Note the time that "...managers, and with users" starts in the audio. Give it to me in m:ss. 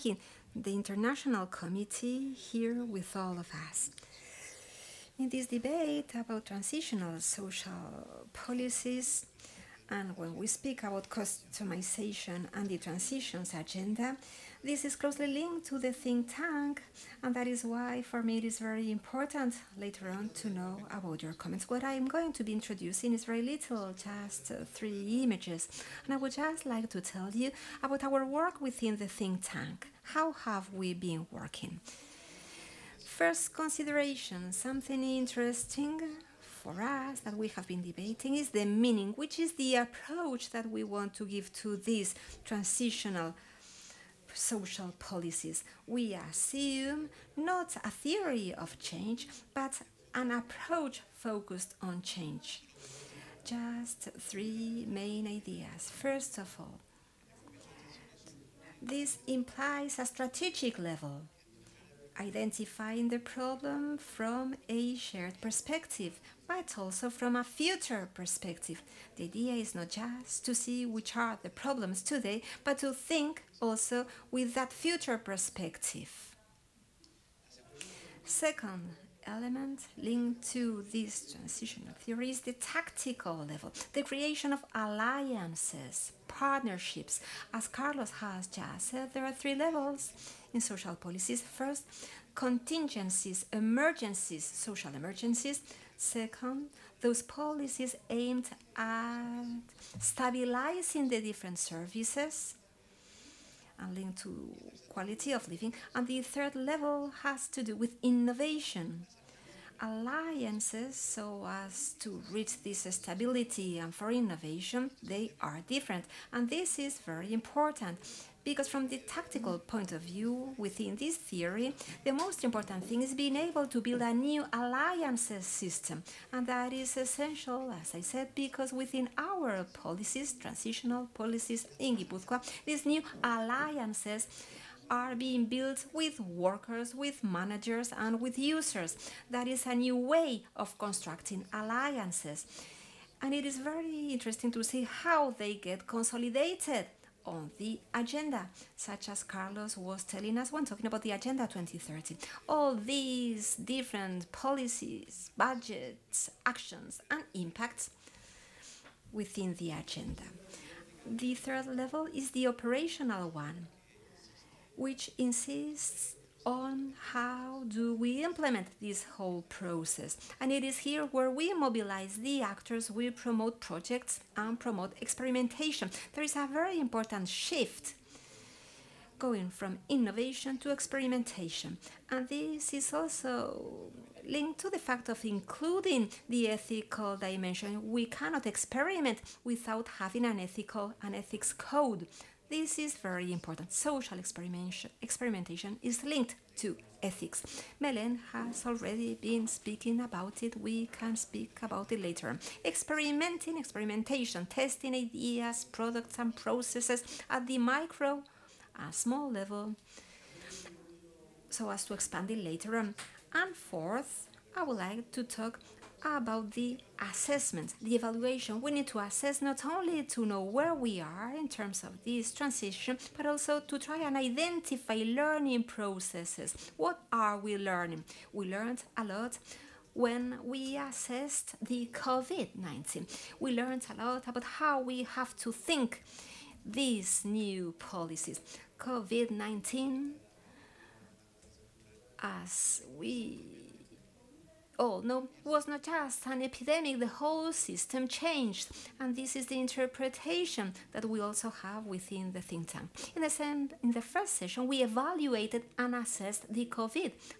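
2:17.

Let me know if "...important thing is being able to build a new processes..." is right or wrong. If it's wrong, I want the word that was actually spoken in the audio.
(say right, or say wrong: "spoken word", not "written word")
wrong: "alliances", not "processes".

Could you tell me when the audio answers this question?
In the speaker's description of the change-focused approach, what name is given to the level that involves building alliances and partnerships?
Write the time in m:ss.
1:22.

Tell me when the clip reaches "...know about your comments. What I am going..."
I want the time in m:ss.
0:20.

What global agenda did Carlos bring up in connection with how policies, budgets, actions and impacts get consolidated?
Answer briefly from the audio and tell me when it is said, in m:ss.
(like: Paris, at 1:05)
Agenda 2030, at 2:31.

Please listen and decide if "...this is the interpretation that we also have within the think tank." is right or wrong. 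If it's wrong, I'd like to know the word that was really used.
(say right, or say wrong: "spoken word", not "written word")
right.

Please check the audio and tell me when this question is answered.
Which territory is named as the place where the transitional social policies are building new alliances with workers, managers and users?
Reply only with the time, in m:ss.
2:11.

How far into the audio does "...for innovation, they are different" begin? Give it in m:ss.
1:53.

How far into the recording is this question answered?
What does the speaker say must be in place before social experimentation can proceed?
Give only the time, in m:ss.
3:11.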